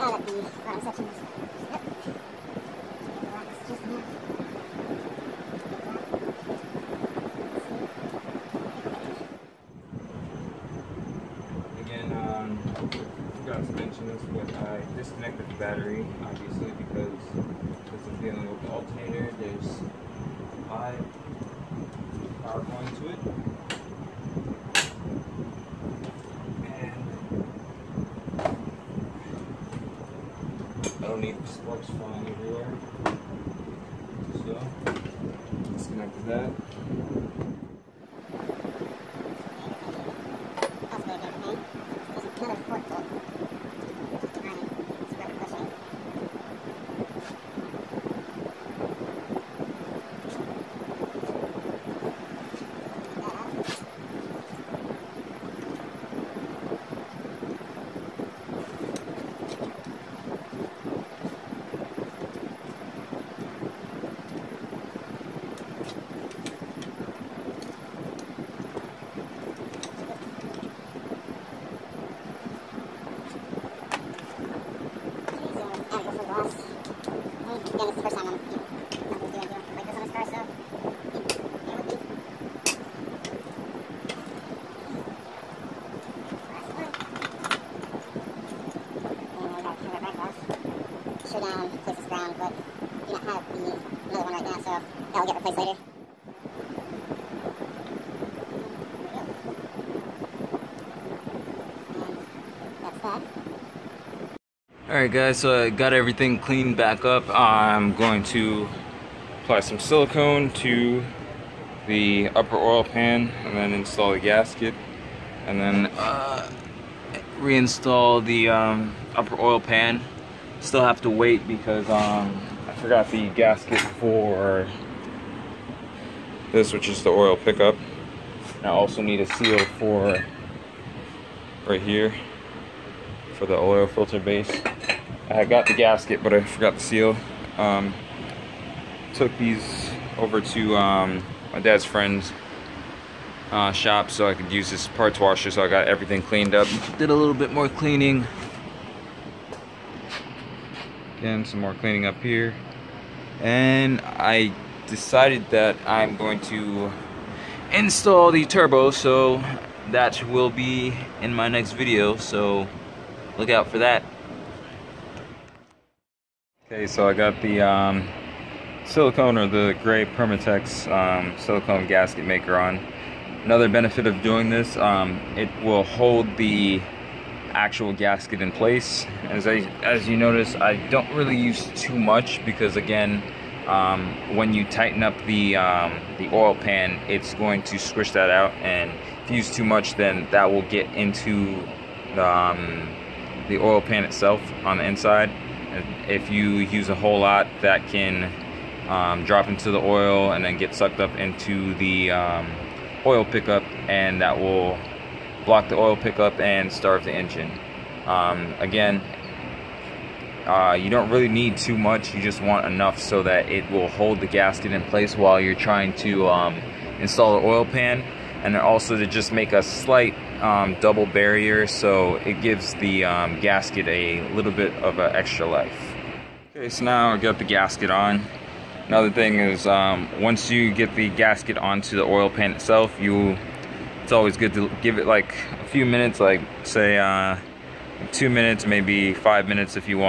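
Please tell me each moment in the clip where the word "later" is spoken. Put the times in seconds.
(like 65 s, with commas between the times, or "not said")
95 s.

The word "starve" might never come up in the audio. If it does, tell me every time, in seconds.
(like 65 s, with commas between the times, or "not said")
206 s.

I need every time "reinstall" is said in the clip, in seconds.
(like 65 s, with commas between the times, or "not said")
117 s.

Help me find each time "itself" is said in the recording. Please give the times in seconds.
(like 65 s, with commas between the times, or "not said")
194 s, 232 s.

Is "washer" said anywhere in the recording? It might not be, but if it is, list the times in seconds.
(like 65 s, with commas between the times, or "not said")
145 s.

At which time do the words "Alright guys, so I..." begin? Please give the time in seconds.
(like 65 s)
104 s.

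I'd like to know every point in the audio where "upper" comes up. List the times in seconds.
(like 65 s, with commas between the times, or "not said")
112 s, 119 s.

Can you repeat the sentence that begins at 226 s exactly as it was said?
Okay, so now I got the gasket on.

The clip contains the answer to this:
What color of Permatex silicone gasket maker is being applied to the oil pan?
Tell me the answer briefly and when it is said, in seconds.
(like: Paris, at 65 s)
gray, at 169 s.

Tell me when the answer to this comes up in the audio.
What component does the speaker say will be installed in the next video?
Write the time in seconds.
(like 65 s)
158 s.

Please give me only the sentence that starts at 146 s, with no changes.
Did a little bit more cleaning.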